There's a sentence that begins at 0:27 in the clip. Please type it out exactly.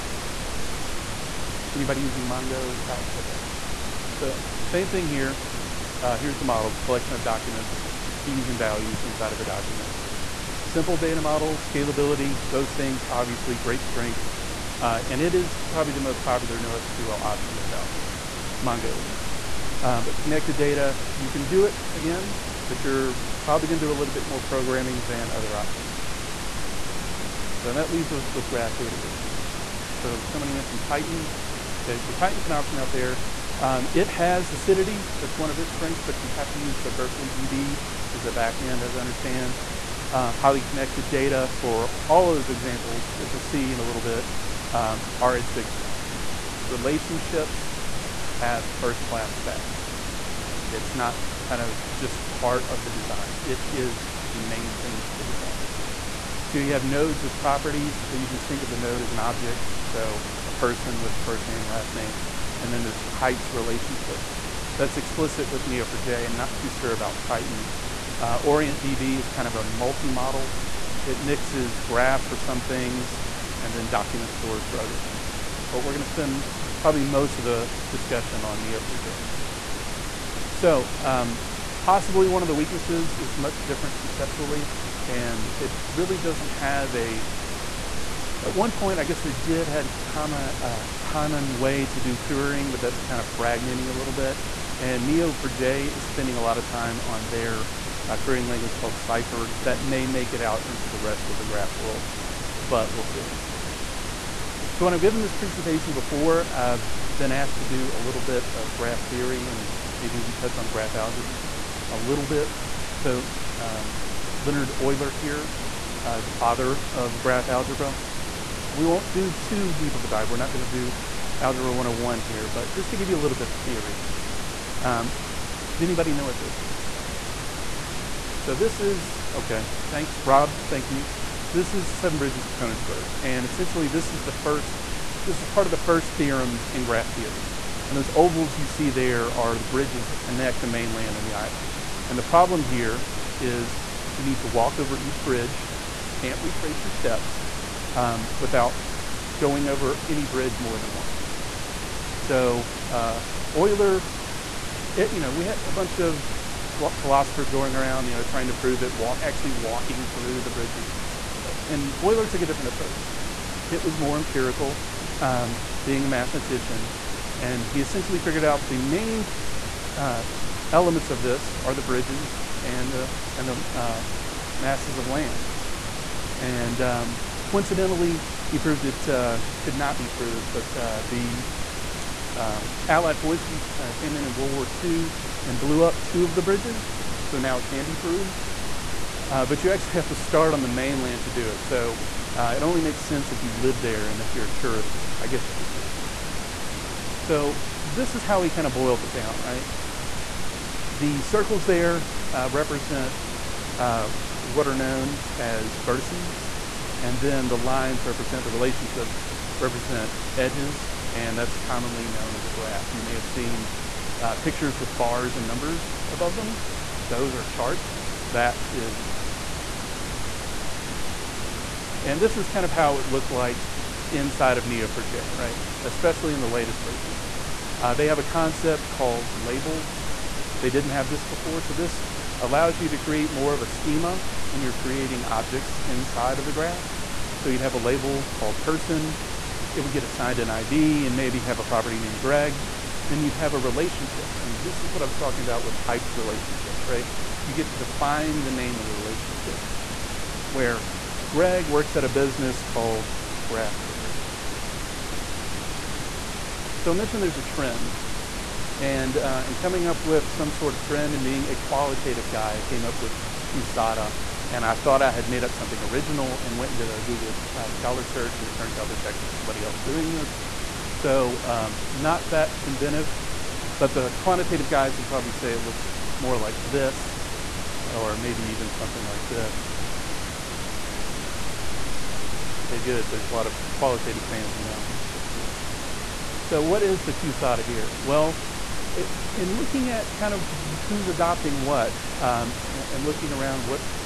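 So that leaves us with graph databases.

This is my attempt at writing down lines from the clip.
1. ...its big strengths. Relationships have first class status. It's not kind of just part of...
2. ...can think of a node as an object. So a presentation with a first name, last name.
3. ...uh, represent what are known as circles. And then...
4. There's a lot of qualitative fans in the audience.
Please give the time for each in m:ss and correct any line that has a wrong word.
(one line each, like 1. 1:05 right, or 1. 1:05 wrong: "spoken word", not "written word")
1. 0:45 right
2. 0:58 wrong: "person", not "presentation"
3. 3:22 wrong: "vertices", not "circles"
4. 4:43 right.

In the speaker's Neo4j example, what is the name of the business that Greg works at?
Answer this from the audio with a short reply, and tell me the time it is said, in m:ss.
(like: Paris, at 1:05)
Graph Story, at 4:13.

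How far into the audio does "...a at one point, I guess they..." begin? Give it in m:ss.
1:26.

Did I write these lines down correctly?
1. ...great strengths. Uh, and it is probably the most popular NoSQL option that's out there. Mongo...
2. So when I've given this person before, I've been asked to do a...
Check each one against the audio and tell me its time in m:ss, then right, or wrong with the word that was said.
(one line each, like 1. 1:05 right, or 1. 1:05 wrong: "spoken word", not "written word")
1. 0:13 right
2. 1:44 wrong: "presentation", not "person".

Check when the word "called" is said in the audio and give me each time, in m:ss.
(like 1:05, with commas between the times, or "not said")
1:38, 3:48, 3:58, 4:12.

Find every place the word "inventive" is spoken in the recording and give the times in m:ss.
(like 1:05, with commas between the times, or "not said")
4:32.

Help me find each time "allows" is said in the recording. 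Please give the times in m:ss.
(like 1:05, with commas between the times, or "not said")
3:52.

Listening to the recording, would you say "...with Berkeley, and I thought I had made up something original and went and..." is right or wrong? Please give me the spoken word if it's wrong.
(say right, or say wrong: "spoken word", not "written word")
wrong: "QSADA", not "Berkeley".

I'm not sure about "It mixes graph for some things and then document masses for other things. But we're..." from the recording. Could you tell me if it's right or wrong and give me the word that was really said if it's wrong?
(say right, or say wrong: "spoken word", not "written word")
wrong: "stores", not "masses".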